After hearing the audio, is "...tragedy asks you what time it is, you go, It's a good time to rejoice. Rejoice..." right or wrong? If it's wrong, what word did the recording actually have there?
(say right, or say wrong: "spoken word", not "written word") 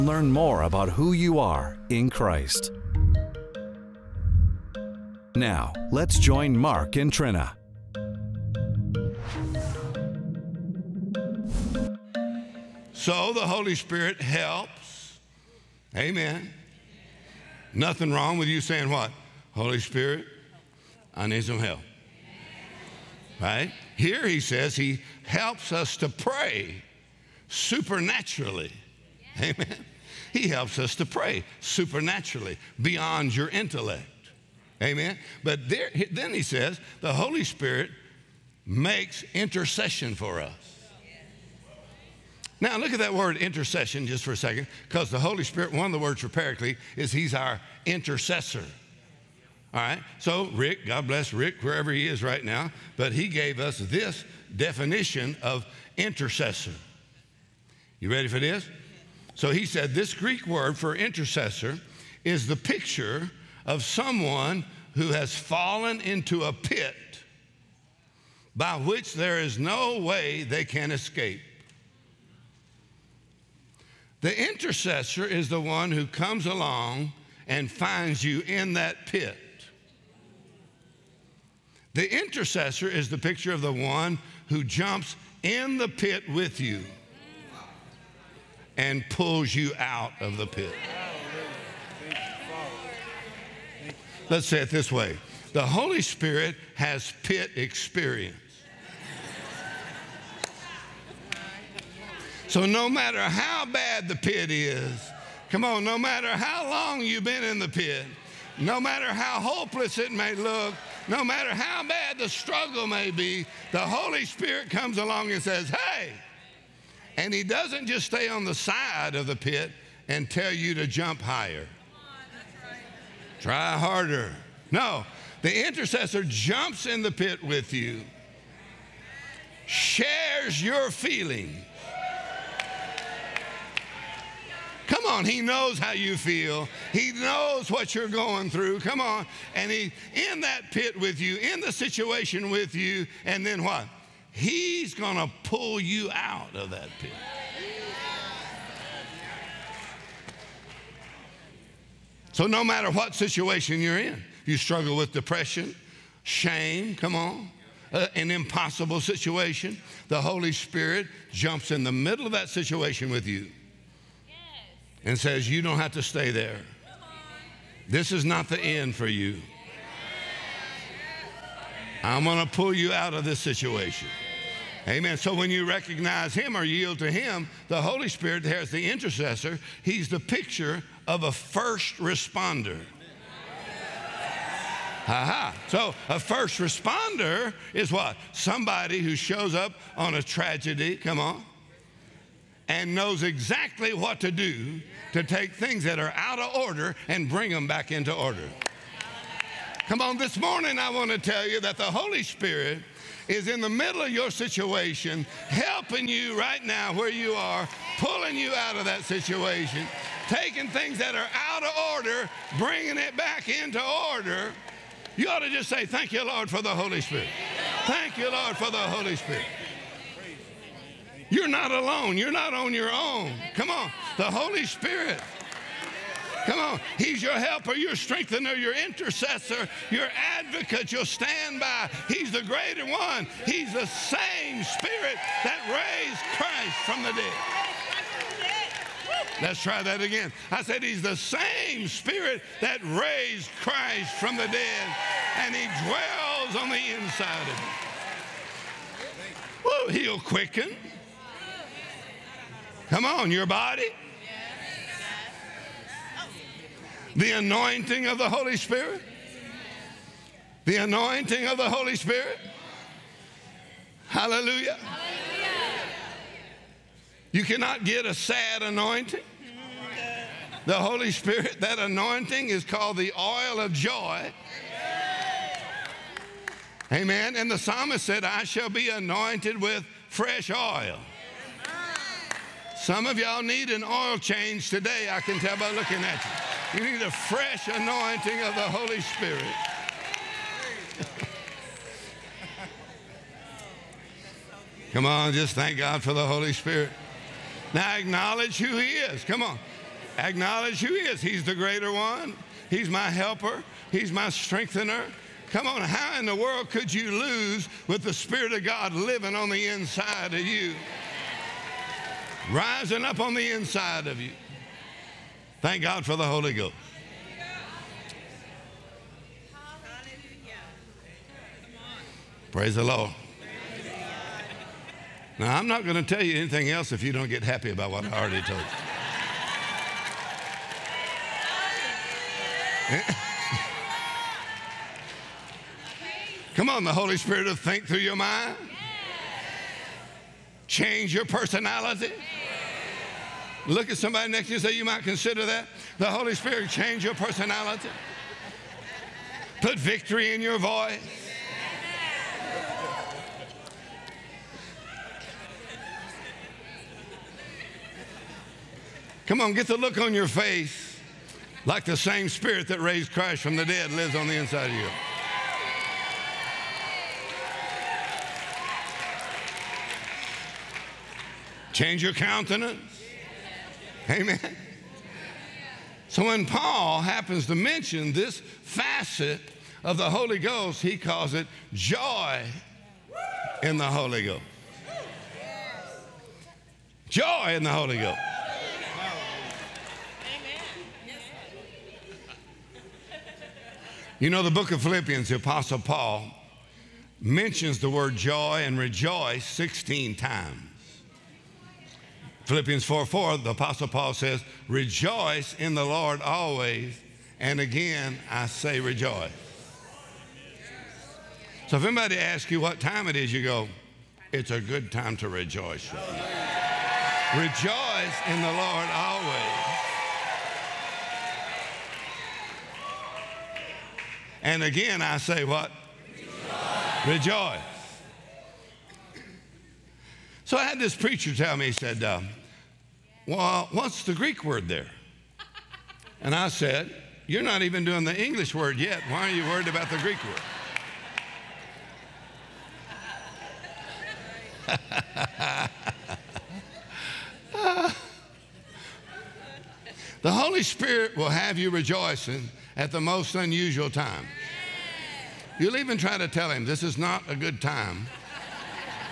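wrong: "anybody", not "tragedy".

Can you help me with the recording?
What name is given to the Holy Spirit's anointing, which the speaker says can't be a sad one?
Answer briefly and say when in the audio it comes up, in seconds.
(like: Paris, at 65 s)
Oil of joy, at 273 s.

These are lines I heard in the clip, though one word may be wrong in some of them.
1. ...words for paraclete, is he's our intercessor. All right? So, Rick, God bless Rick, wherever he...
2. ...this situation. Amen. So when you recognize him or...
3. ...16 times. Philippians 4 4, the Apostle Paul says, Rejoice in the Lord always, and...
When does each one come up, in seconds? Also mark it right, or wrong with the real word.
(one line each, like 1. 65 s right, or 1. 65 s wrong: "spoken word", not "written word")
1. 45 s right
2. 173 s right
3. 399 s right.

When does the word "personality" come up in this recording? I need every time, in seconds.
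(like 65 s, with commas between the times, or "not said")
341 s, 347 s.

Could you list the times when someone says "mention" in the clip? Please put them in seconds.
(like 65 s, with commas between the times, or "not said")
377 s, 397 s.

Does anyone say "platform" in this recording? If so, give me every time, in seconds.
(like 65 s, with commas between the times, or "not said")
not said.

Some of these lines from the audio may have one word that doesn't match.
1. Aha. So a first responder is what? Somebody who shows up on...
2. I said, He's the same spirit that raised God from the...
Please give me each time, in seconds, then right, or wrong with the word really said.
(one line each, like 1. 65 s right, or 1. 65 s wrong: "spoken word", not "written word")
1. 185 s right
2. 240 s wrong: "Christ", not "God".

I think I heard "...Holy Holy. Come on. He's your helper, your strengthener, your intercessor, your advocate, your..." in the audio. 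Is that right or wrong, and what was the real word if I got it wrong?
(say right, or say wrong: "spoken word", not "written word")
wrong: "Spirit", not "Holy".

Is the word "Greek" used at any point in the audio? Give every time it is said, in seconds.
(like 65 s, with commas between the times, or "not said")
60 s, 434 s, 439 s.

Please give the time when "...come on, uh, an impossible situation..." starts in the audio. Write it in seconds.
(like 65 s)
156 s.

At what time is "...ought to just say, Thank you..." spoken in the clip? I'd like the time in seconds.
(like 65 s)
215 s.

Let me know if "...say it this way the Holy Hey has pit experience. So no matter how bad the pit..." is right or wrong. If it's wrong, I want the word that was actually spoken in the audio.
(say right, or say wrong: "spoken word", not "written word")
wrong: "Spirit", not "Hey".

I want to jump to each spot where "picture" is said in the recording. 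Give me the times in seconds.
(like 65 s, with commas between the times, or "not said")
62 s, 83 s, 180 s.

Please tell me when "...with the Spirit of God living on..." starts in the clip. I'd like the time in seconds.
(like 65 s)
307 s.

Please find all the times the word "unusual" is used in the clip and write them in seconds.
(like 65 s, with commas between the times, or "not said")
453 s.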